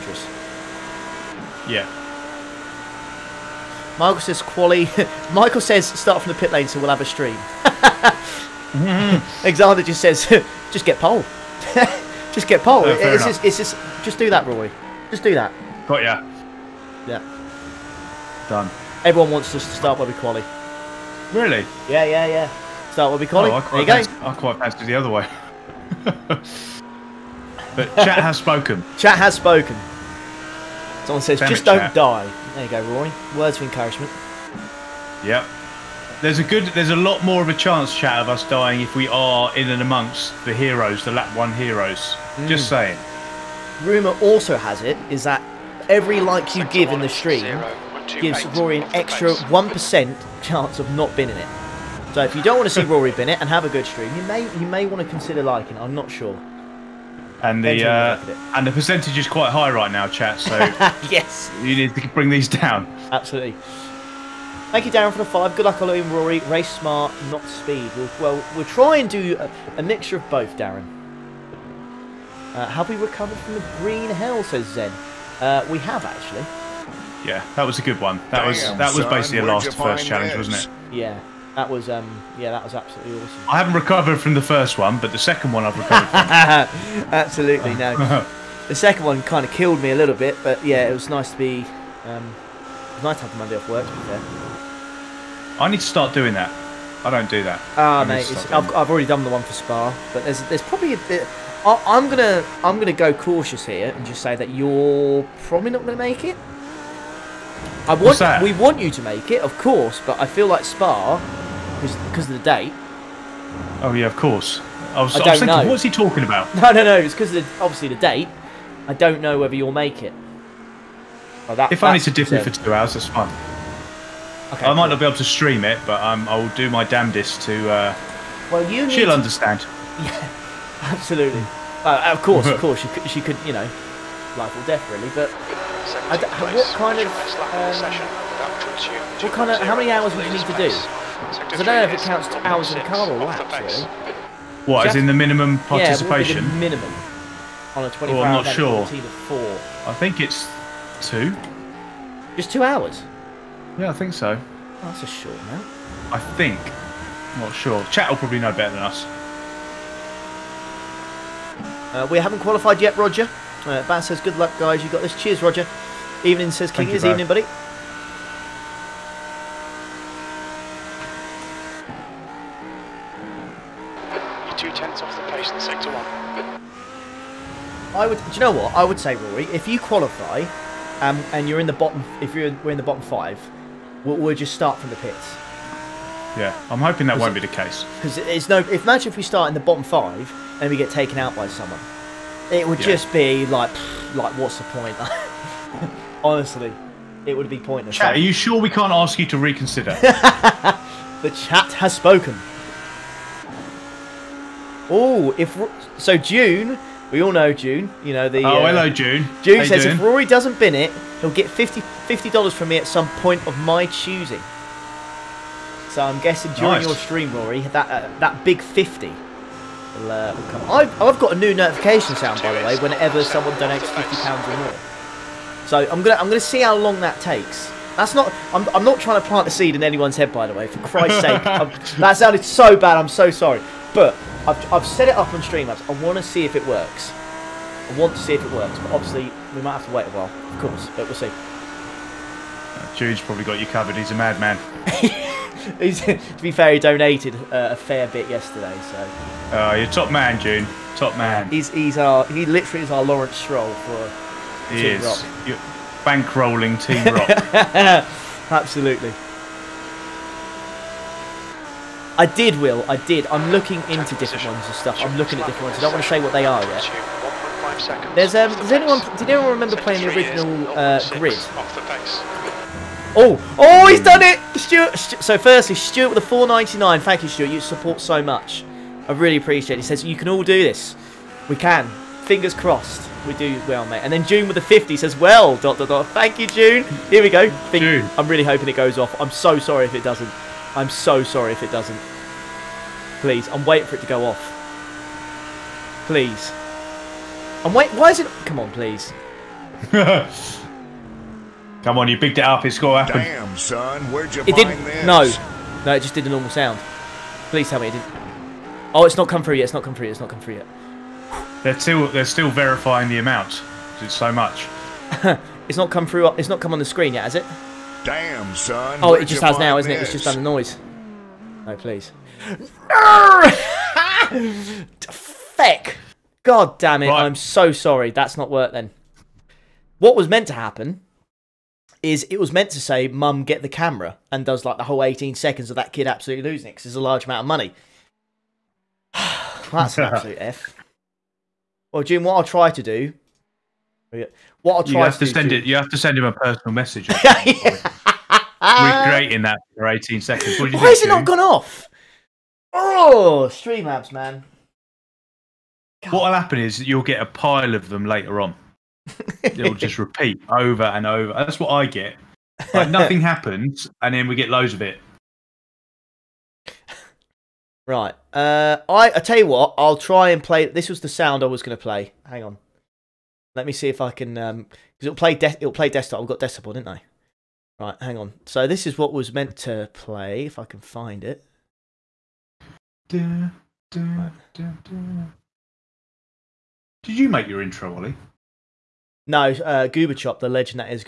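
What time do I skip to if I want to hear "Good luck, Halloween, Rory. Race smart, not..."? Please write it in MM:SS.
01:05.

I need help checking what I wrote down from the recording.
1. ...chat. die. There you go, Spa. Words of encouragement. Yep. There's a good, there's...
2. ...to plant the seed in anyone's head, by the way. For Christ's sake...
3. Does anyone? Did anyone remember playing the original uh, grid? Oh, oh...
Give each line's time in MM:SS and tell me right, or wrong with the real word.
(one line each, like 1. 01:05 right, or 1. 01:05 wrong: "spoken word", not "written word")
1. 00:31 wrong: "Roy", not "Spa"
2. 03:49 right
3. 04:28 right.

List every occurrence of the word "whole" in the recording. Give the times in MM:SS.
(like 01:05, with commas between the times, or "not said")
05:34.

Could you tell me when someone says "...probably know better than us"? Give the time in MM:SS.
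02:38.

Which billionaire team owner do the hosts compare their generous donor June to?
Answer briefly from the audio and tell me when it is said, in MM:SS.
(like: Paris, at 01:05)
Lawrence Stroll, at 04:13.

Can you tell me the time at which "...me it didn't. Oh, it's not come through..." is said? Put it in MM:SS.
05:07.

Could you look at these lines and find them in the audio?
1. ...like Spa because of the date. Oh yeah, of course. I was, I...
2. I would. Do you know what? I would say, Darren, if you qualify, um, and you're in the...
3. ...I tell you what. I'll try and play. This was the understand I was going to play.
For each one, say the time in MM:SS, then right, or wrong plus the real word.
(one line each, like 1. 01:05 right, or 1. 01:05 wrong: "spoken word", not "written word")
1. 01:50 right
2. 02:57 wrong: "Rory", not "Darren"
3. 06:09 wrong: "sound", not "understand".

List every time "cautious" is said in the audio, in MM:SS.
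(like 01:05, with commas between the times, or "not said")
01:43.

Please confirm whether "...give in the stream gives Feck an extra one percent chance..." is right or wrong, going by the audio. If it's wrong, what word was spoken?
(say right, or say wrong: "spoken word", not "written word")
wrong: "Rory", not "Feck".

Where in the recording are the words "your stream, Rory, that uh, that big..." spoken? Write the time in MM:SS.
03:36.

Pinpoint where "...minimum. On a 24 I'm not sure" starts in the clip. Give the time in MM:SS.
02:26.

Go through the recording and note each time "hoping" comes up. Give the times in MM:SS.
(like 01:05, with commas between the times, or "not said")
03:06, 04:48.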